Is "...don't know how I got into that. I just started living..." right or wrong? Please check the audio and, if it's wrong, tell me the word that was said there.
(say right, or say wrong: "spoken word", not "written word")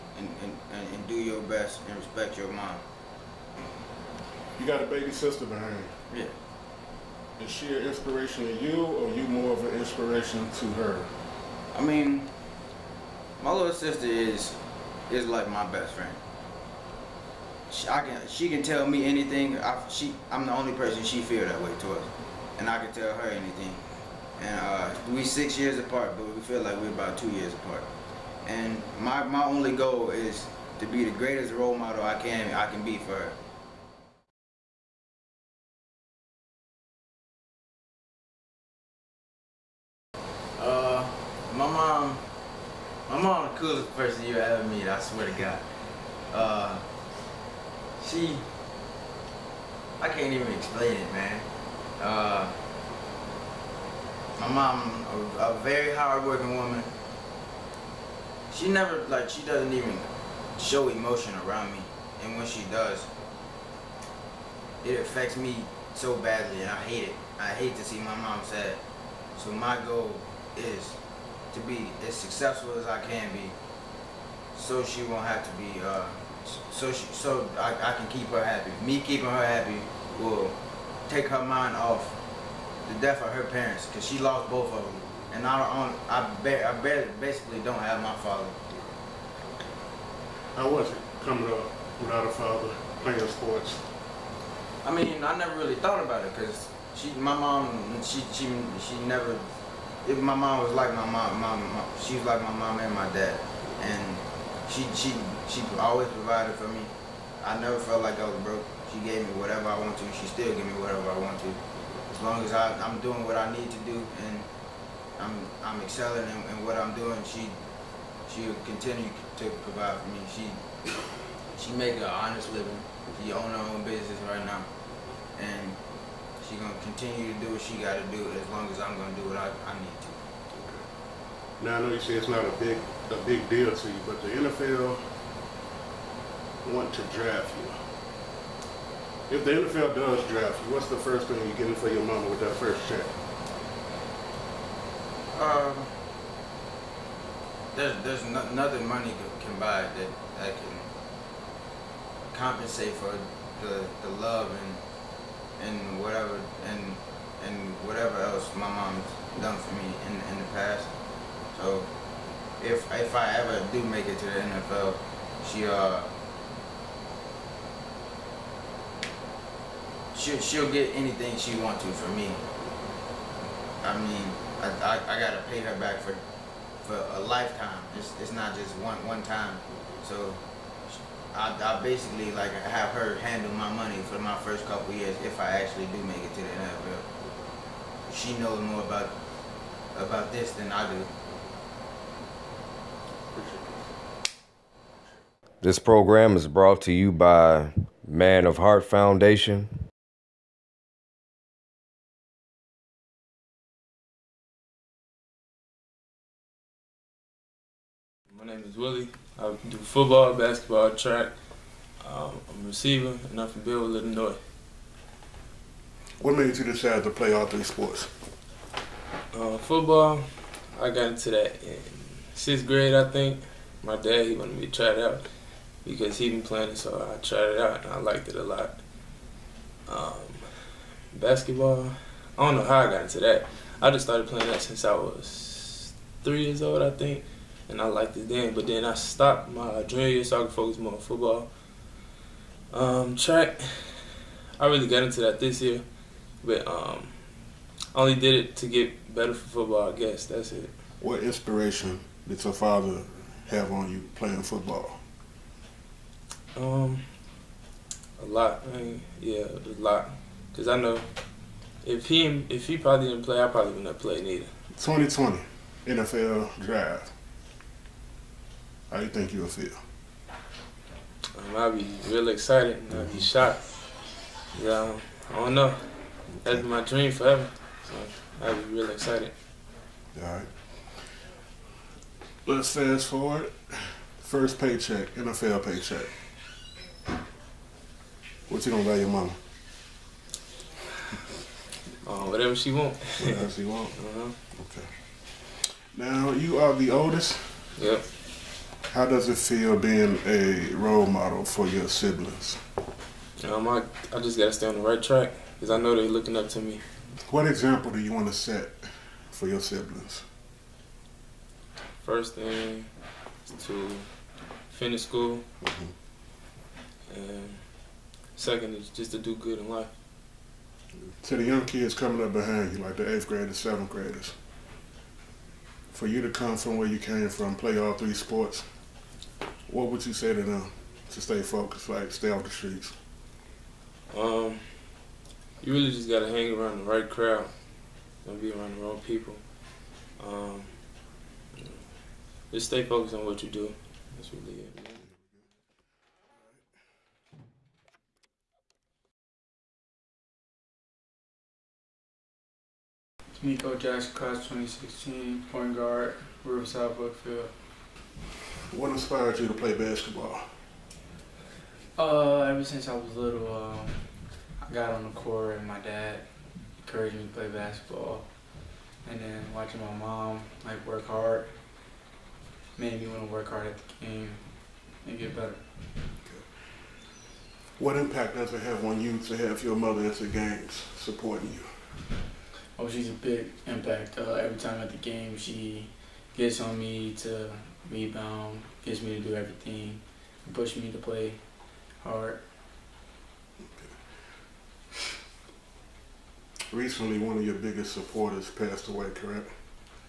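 wrong: "playing", not "living".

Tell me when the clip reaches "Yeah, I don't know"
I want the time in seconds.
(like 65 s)
274 s.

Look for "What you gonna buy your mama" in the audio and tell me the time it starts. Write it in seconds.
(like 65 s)
288 s.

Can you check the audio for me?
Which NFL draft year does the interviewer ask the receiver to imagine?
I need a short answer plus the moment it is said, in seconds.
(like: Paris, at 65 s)
2020, at 264 s.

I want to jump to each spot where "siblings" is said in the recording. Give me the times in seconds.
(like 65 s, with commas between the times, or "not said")
301 s, 309 s.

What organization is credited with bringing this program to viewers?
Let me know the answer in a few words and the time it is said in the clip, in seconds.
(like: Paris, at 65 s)
Man of Heart Foundation, at 198 s.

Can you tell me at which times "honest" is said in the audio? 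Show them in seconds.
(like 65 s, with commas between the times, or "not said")
122 s.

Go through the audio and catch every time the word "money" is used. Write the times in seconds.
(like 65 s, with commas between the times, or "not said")
148 s, 183 s.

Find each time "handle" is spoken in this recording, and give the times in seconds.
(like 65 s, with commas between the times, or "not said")
183 s.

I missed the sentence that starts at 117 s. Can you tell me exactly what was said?
She she'll continue to provide for me.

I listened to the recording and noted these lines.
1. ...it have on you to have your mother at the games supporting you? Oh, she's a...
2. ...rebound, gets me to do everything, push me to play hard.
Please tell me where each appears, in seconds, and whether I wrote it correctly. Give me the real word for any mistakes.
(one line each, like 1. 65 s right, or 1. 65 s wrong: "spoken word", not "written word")
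1. 378 s right
2. 387 s right.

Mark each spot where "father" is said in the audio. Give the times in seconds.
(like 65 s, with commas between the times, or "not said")
88 s, 92 s, 252 s.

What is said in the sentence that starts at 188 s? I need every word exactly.
She knows more about about this than I do.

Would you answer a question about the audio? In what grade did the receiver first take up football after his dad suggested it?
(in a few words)
6th grade.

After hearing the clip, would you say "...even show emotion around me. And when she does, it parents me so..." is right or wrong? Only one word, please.
wrong.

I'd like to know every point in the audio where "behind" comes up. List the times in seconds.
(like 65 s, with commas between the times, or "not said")
5 s, 322 s.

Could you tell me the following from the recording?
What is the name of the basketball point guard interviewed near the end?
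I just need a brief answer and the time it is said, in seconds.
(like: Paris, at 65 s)
Nico Jackson, at 353 s.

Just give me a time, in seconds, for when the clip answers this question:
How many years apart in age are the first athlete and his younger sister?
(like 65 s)
25 s.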